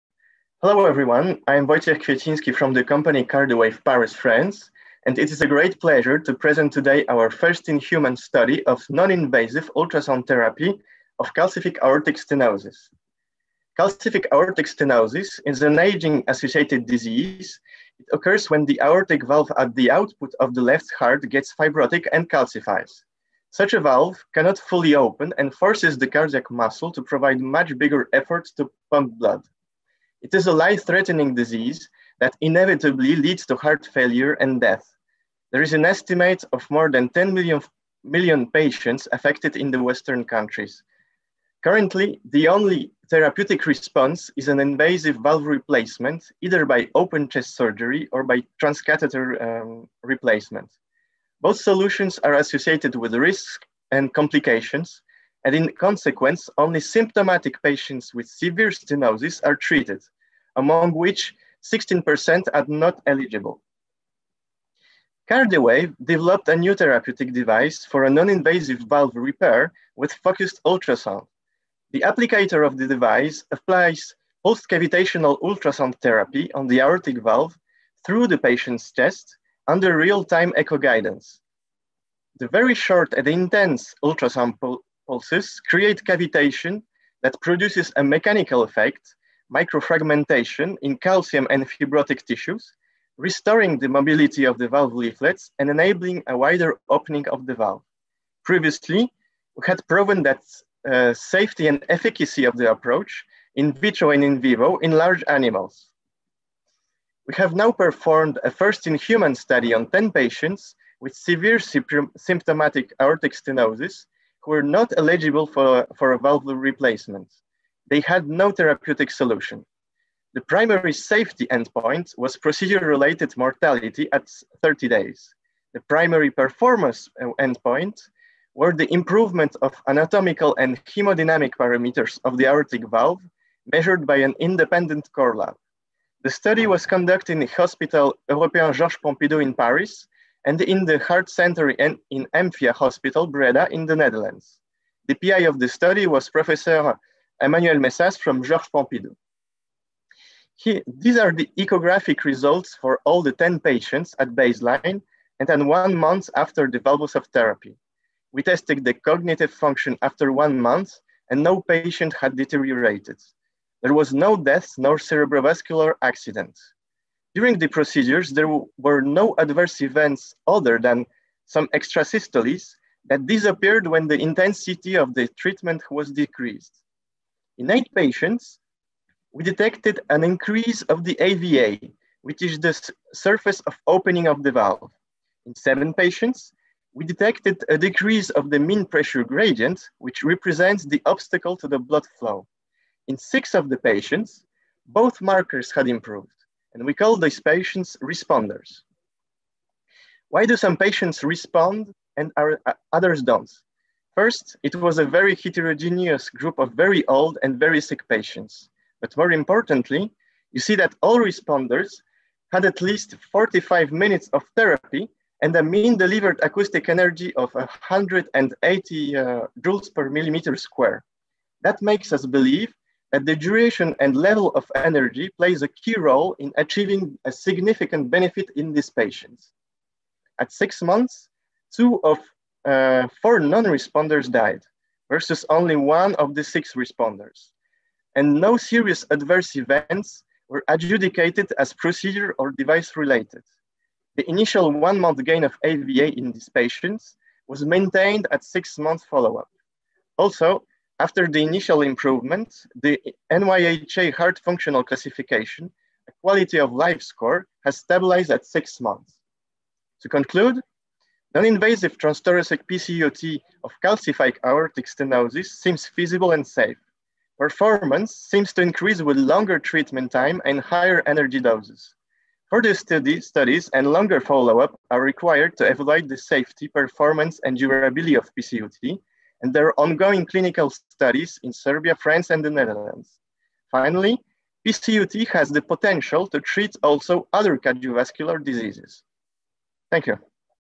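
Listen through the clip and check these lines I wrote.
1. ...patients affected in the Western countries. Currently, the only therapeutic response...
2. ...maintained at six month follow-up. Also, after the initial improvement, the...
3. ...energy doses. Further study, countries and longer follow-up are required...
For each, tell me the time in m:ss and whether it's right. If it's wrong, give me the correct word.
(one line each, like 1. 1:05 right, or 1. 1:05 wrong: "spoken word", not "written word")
1. 0:38 right
2. 4:07 right
3. 4:31 wrong: "studies", not "countries".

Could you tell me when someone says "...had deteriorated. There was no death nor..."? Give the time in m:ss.
2:42.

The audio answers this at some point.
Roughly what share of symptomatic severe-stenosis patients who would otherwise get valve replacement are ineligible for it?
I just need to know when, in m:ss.
1:01.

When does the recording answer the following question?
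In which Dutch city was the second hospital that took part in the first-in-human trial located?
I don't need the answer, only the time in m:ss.
2:23.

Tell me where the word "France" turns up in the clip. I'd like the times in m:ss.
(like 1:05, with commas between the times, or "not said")
0:04, 4:41.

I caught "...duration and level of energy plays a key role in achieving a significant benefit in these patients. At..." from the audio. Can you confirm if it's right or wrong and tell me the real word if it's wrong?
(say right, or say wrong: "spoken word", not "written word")
right.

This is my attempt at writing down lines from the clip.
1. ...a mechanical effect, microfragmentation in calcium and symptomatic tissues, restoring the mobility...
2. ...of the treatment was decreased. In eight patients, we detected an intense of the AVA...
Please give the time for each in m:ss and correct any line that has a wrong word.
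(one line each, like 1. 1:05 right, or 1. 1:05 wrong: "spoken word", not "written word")
1. 1:27 wrong: "fibrotic", not "symptomatic"
2. 2:54 wrong: "increase", not "intense".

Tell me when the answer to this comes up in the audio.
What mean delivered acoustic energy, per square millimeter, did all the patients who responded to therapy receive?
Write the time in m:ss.
3:37.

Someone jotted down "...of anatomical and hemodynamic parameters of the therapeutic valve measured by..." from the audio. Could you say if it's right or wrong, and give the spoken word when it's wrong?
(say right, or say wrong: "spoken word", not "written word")
wrong: "aortic", not "therapeutic".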